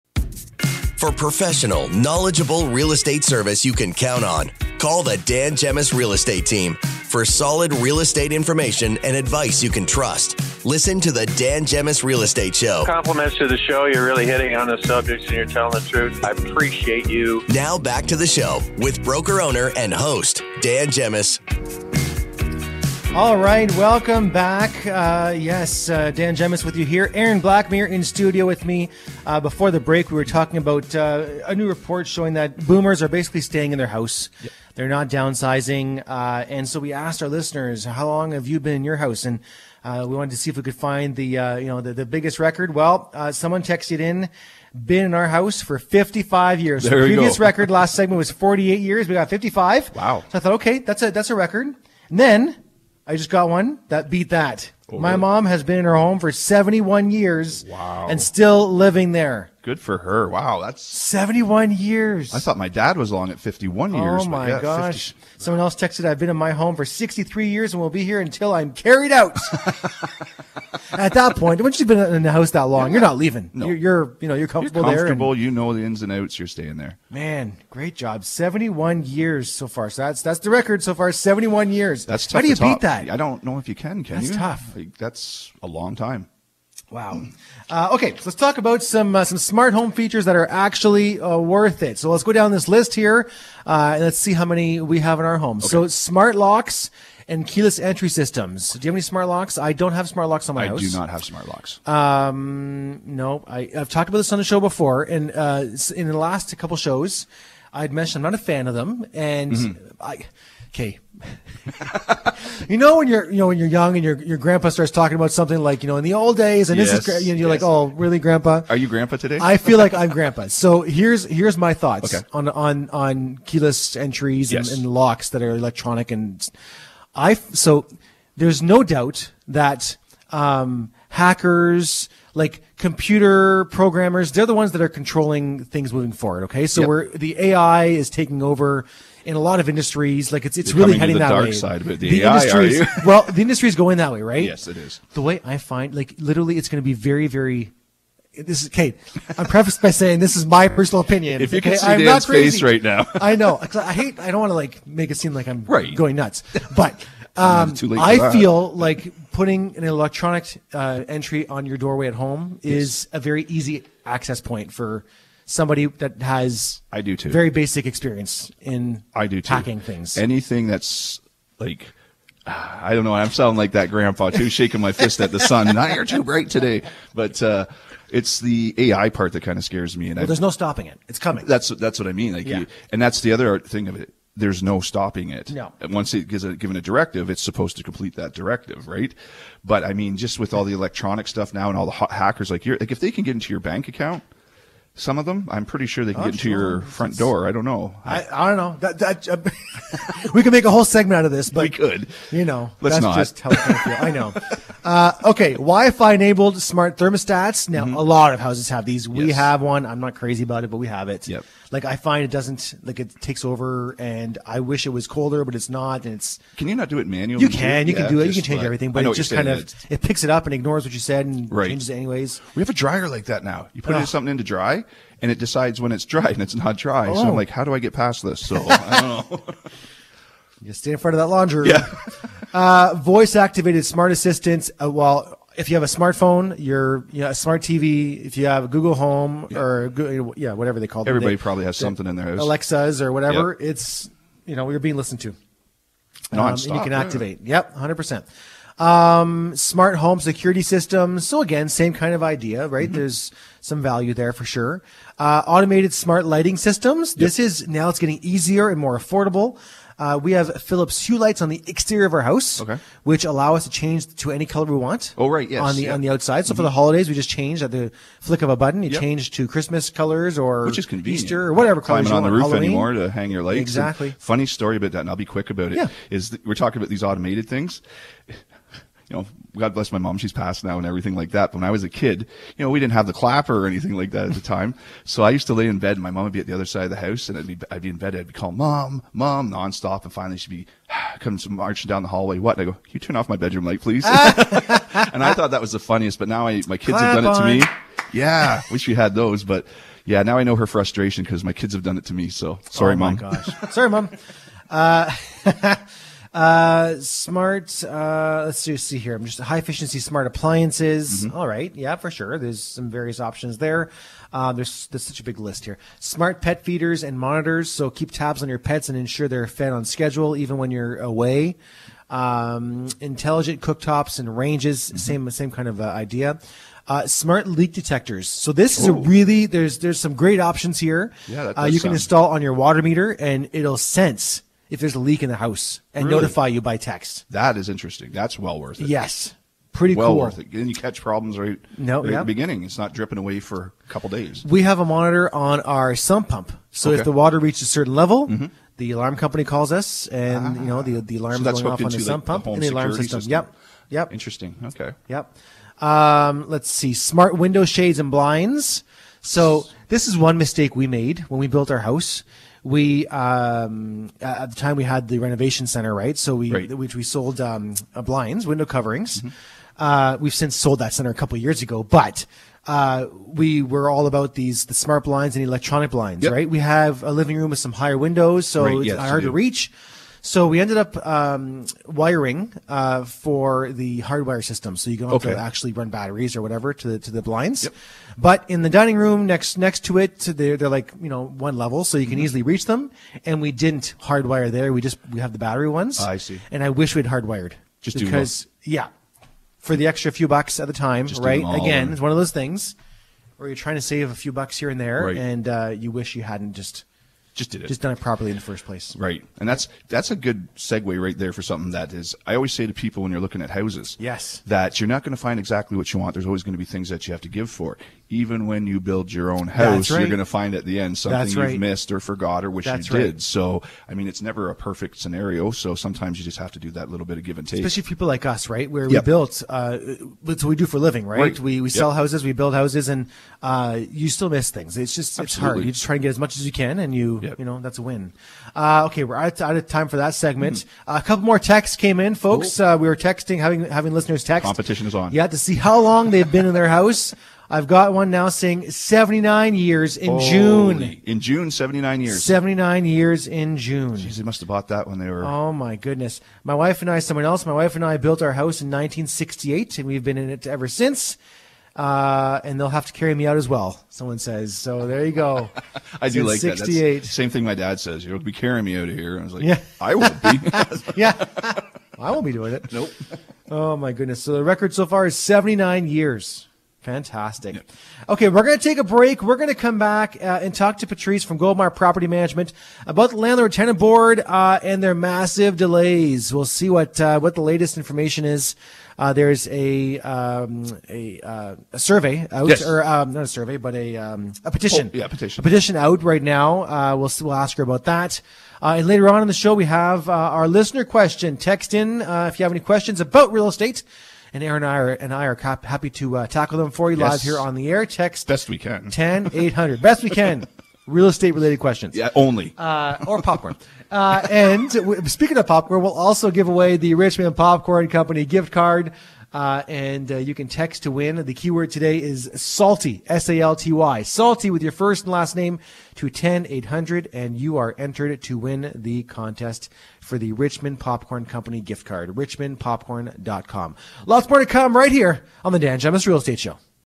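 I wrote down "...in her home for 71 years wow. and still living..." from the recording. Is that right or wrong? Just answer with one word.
right.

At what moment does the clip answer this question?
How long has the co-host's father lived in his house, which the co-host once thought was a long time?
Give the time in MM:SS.
01:03.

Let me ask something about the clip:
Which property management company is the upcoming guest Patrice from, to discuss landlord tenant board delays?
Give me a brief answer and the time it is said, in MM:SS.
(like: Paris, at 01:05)
Goldmar Property Management, at 08:01.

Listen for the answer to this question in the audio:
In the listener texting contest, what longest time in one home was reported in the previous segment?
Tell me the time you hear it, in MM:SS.
00:48.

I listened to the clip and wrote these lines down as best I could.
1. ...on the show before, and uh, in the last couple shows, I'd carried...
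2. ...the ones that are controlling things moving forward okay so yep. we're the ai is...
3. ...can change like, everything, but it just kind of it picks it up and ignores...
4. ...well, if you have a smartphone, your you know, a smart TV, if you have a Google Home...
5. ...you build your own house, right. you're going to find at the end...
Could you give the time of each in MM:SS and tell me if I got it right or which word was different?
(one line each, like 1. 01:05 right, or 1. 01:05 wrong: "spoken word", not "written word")
1. 01:44 wrong: "mentioned", not "carried"
2. 02:14 right
3. 03:38 right
4. 03:54 right
5. 06:58 right.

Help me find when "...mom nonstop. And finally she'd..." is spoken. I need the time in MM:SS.
04:49.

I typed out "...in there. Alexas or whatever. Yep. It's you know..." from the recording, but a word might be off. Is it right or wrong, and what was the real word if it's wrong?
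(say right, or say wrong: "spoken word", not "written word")
right.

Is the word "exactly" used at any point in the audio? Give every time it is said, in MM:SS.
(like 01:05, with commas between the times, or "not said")
04:33, 06:55.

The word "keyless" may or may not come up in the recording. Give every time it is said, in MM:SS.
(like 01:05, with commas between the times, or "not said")
01:37, 02:03.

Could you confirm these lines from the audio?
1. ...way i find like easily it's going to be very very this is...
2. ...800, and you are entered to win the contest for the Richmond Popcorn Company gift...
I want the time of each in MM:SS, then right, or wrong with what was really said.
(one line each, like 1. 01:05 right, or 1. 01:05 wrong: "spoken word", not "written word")
1. 02:25 wrong: "literally", not "easily"
2. 08:46 right.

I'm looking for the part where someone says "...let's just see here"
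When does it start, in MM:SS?
05:08.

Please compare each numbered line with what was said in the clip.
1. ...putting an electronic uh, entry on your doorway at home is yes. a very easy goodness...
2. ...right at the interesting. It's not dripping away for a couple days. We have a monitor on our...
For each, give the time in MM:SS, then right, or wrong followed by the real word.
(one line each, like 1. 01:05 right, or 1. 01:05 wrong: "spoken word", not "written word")
1. 02:39 wrong: "access", not "goodness"
2. 05:42 wrong: "beginning", not "interesting".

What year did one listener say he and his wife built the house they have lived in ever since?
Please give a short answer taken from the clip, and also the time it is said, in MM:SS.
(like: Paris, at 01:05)
1968, at 07:38.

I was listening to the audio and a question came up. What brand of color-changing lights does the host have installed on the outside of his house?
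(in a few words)
Philips Hue.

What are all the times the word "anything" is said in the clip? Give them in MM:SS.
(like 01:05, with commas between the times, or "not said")
02:50, 04:43.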